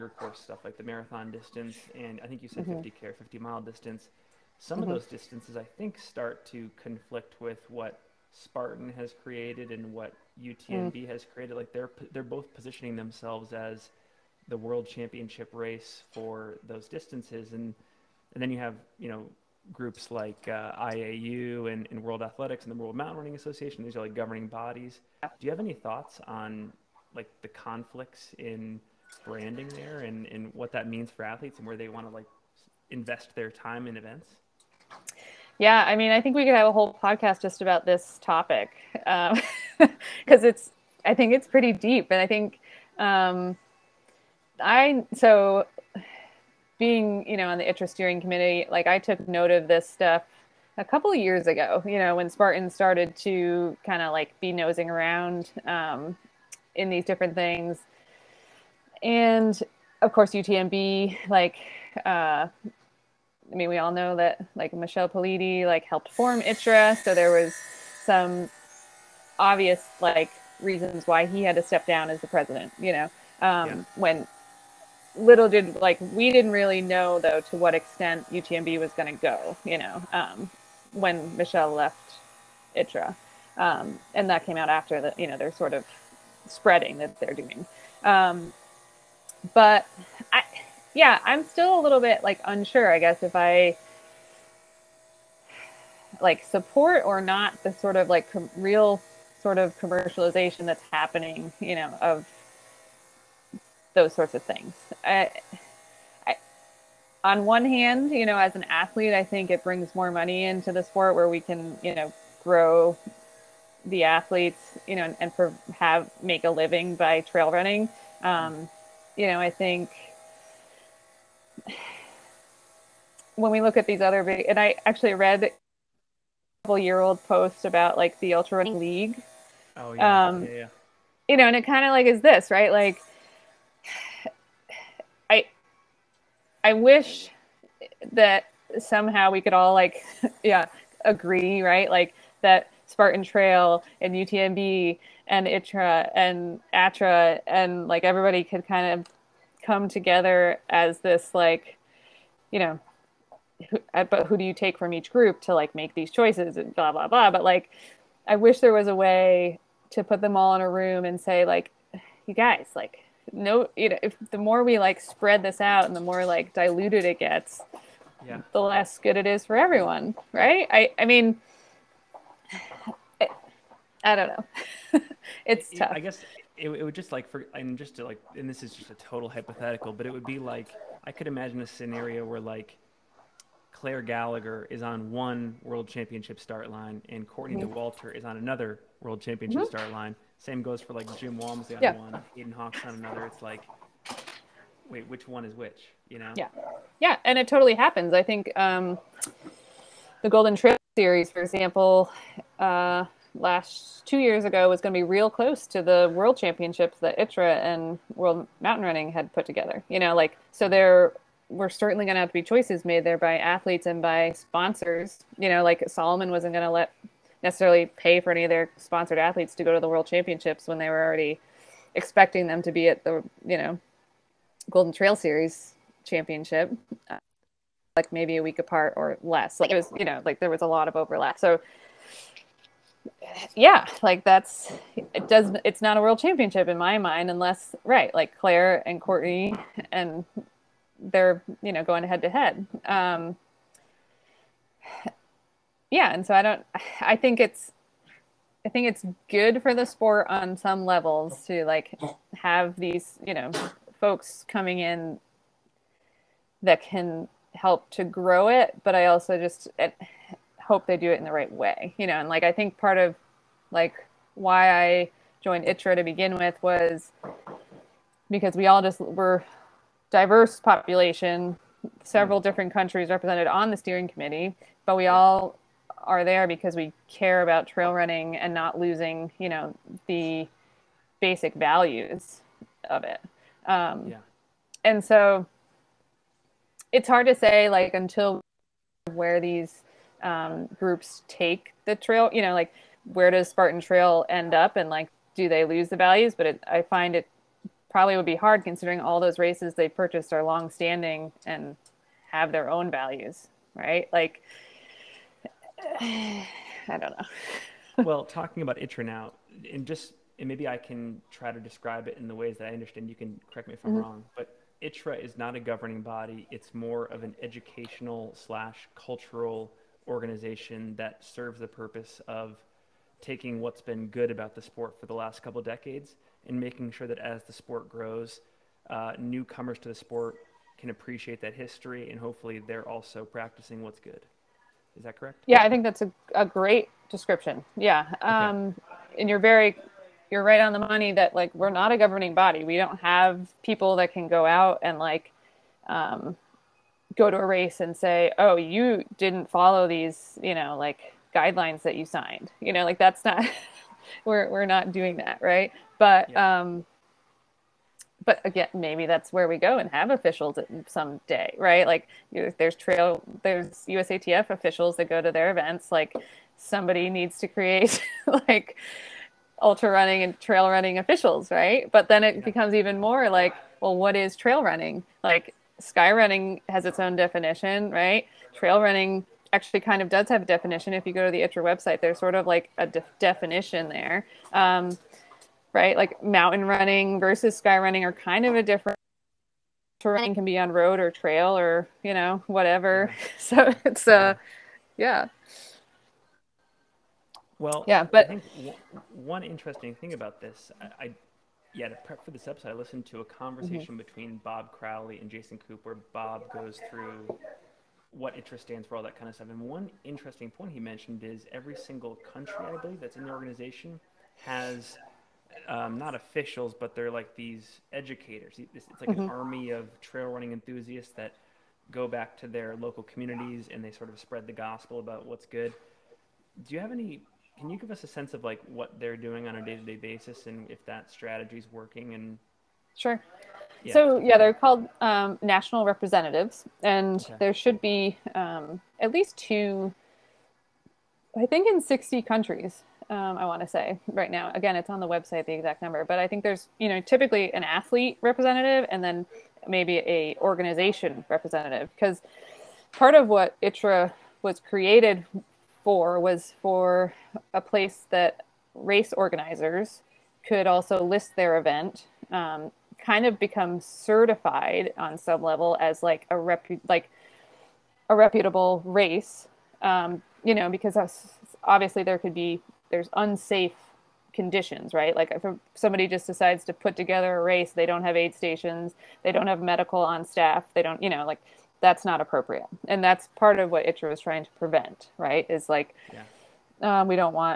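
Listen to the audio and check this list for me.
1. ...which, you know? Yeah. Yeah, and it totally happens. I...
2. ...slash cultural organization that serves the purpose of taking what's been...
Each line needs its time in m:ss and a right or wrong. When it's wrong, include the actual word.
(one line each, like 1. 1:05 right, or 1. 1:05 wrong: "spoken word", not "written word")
1. 3:15 right
2. 5:18 right.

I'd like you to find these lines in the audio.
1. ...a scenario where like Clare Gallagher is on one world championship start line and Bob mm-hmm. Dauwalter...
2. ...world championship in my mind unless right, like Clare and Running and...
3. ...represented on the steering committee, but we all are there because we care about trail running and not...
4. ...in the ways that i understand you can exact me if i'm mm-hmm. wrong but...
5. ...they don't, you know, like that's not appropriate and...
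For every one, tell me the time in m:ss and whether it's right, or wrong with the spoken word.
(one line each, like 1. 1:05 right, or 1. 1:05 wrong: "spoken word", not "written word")
1. 3:01 wrong: "Courtney", not "Bob"
2. 3:56 wrong: "Courtney", not "Running"
3. 4:33 right
4. 5:12 wrong: "correct", not "exact"
5. 8:00 right.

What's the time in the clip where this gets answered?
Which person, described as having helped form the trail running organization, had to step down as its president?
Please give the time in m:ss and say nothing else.
1:04.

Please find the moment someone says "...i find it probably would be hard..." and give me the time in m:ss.
4:56.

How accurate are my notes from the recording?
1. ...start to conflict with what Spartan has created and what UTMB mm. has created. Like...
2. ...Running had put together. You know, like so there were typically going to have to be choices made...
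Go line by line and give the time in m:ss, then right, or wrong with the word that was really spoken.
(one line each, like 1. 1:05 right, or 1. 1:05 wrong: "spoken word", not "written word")
1. 0:05 right
2. 3:28 wrong: "certainly", not "typically".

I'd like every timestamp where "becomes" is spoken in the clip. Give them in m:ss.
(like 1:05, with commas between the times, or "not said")
6:12, 7:43.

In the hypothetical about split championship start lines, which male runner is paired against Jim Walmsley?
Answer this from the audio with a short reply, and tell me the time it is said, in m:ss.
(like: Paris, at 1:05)
Hayden Hawks, at 3:12.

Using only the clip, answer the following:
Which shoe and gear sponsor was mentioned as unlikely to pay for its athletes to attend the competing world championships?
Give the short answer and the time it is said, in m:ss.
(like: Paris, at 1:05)
Salomon, at 3:35.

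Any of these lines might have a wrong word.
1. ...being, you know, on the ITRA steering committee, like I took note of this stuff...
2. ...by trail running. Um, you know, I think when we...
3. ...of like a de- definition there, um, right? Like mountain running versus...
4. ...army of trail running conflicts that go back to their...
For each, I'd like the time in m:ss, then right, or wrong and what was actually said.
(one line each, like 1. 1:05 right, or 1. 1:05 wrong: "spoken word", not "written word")
1. 0:46 right
2. 1:56 right
3. 6:22 right
4. 6:59 wrong: "enthusiasts", not "conflicts".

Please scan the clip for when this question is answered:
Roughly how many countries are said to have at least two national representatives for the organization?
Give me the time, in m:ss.
7:21.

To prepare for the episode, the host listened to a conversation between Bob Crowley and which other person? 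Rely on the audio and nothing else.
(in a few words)
Jason Koop.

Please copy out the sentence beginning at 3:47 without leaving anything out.
Uh, like maybe a week apart or less.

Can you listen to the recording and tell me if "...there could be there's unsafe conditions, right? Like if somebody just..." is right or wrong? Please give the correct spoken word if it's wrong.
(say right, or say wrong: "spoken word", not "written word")
right.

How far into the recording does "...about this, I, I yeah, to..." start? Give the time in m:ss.
6:40.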